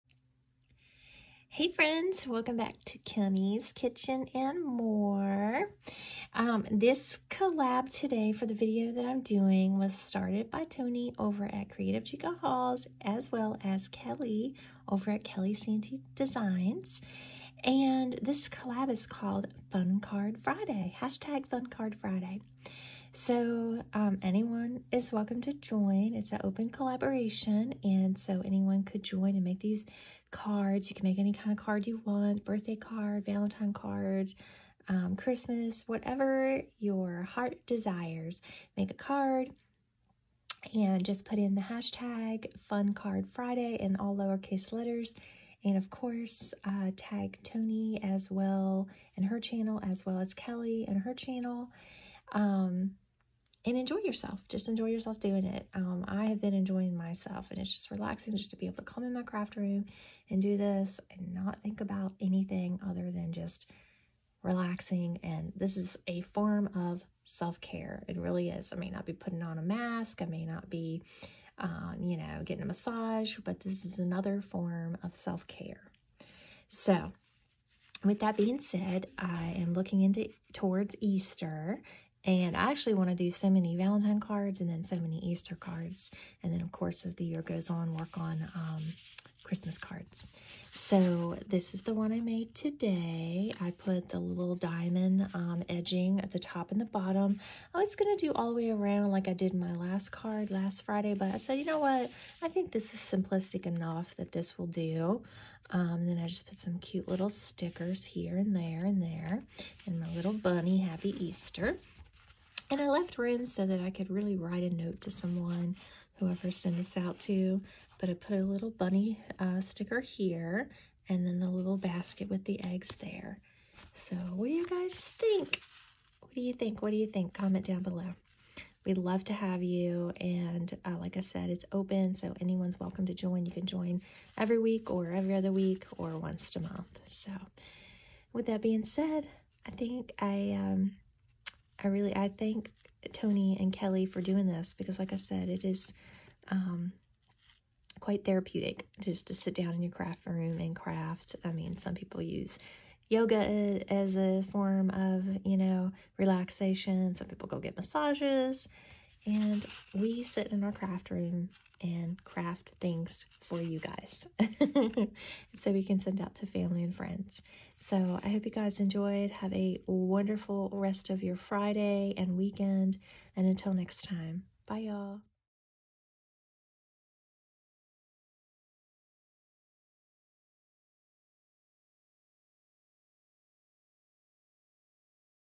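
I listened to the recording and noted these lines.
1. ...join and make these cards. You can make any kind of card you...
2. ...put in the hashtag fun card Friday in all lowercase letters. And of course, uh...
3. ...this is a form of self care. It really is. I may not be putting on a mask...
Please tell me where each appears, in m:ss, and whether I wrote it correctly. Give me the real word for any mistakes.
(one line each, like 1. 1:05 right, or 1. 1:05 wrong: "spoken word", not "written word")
1. 0:29 right
2. 0:41 right
3. 1:05 right.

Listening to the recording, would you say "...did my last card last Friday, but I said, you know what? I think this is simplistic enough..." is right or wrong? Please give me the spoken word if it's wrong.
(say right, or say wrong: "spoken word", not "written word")
right.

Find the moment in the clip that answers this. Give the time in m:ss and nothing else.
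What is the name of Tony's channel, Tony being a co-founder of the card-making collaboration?
0:11.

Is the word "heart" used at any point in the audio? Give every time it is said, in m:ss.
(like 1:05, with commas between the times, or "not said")
0:37.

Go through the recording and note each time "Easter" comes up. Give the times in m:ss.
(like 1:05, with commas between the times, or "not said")
1:20, 1:25, 1:51.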